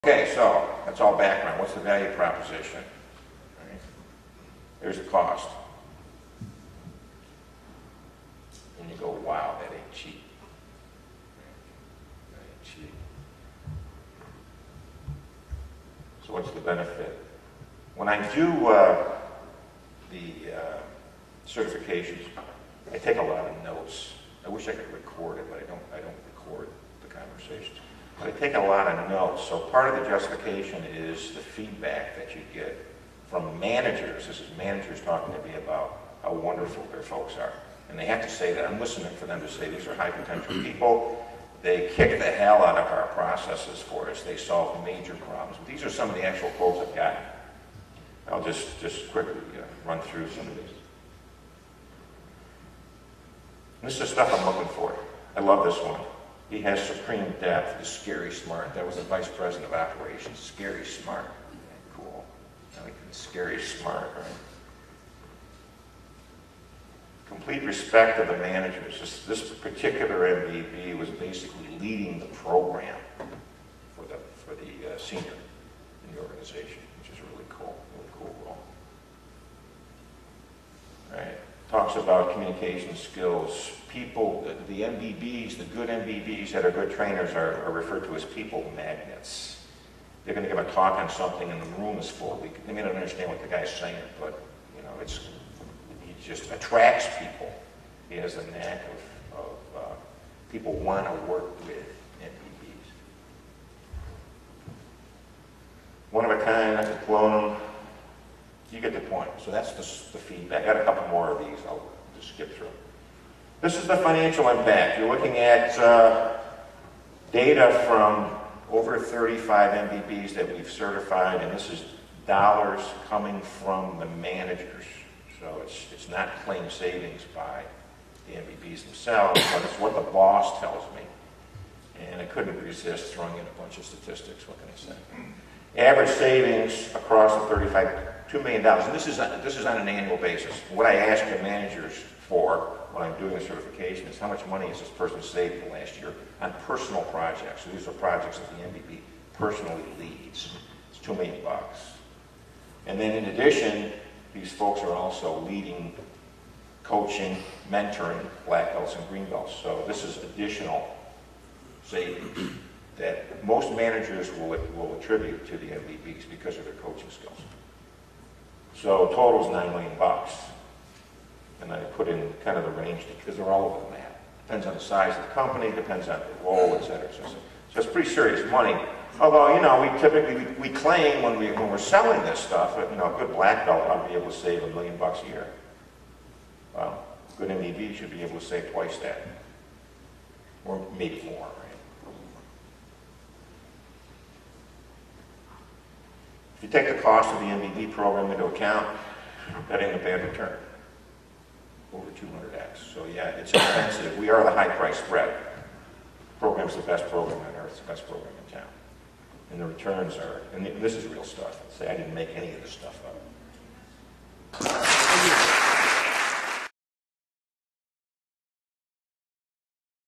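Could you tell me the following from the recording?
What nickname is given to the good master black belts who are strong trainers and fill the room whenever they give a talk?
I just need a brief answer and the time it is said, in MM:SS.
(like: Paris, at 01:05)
People magnets, at 01:28.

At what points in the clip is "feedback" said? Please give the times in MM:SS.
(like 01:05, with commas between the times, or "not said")
00:31, 01:50.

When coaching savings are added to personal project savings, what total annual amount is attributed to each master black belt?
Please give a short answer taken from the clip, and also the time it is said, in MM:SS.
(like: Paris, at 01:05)
$9 million, at 02:49.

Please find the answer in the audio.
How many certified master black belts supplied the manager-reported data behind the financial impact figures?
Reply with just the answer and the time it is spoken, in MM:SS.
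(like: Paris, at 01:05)
Over 35, at 01:58.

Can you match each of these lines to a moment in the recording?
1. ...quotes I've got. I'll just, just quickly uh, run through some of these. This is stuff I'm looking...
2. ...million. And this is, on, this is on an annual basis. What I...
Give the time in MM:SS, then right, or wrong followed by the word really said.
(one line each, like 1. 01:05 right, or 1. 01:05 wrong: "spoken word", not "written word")
1. 00:46 right
2. 02:18 right.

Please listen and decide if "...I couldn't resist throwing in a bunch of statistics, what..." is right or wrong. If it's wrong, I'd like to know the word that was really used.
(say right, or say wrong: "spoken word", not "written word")
right.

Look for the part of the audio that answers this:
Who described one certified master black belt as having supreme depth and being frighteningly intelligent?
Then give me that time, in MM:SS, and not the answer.
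00:59.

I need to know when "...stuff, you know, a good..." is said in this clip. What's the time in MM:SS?
03:02.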